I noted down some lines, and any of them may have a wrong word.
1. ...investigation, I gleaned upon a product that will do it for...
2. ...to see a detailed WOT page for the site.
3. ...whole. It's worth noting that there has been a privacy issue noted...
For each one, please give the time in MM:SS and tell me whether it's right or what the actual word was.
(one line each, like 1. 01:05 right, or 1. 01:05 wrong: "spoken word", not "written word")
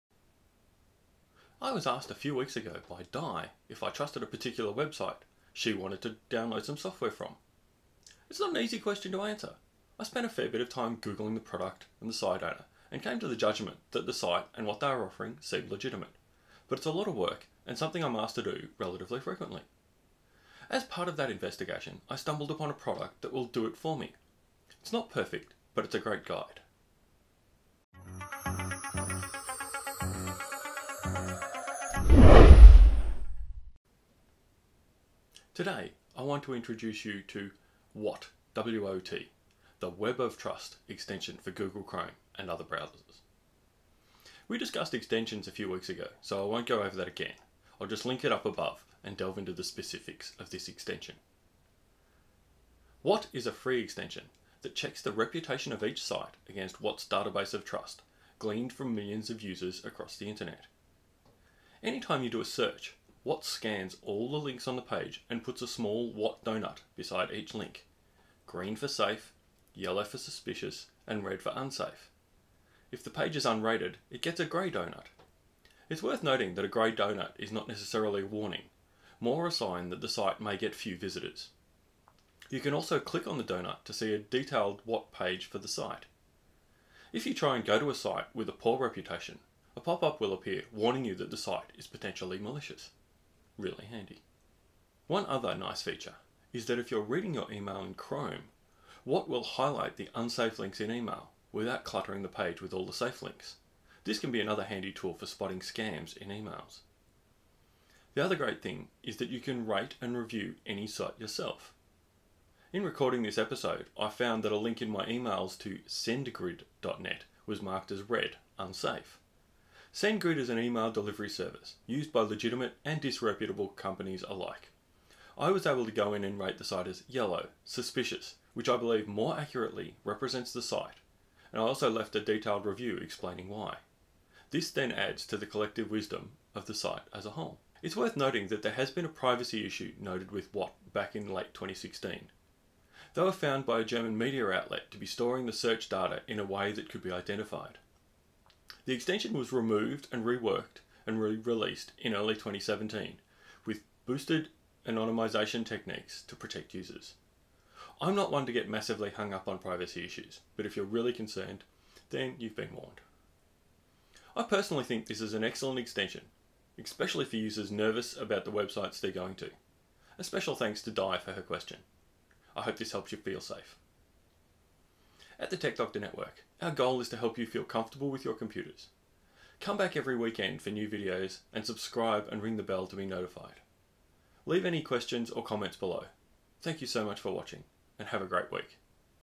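1. 00:21 wrong: "stumbled", not "gleaned"
2. 01:23 right
3. 02:17 right.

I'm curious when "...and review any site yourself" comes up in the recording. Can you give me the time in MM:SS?
01:50.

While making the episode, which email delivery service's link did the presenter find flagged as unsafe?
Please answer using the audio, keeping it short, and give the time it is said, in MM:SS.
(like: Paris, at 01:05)
SendGrid, at 01:55.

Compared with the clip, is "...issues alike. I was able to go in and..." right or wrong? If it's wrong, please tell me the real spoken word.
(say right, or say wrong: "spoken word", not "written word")
wrong: "companies", not "issues".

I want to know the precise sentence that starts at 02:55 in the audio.
At the Tech Doctor Network, our goal is to help you feel comfortable with your computers.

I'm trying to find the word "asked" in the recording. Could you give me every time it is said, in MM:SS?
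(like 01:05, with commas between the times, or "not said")
00:01, 00:18.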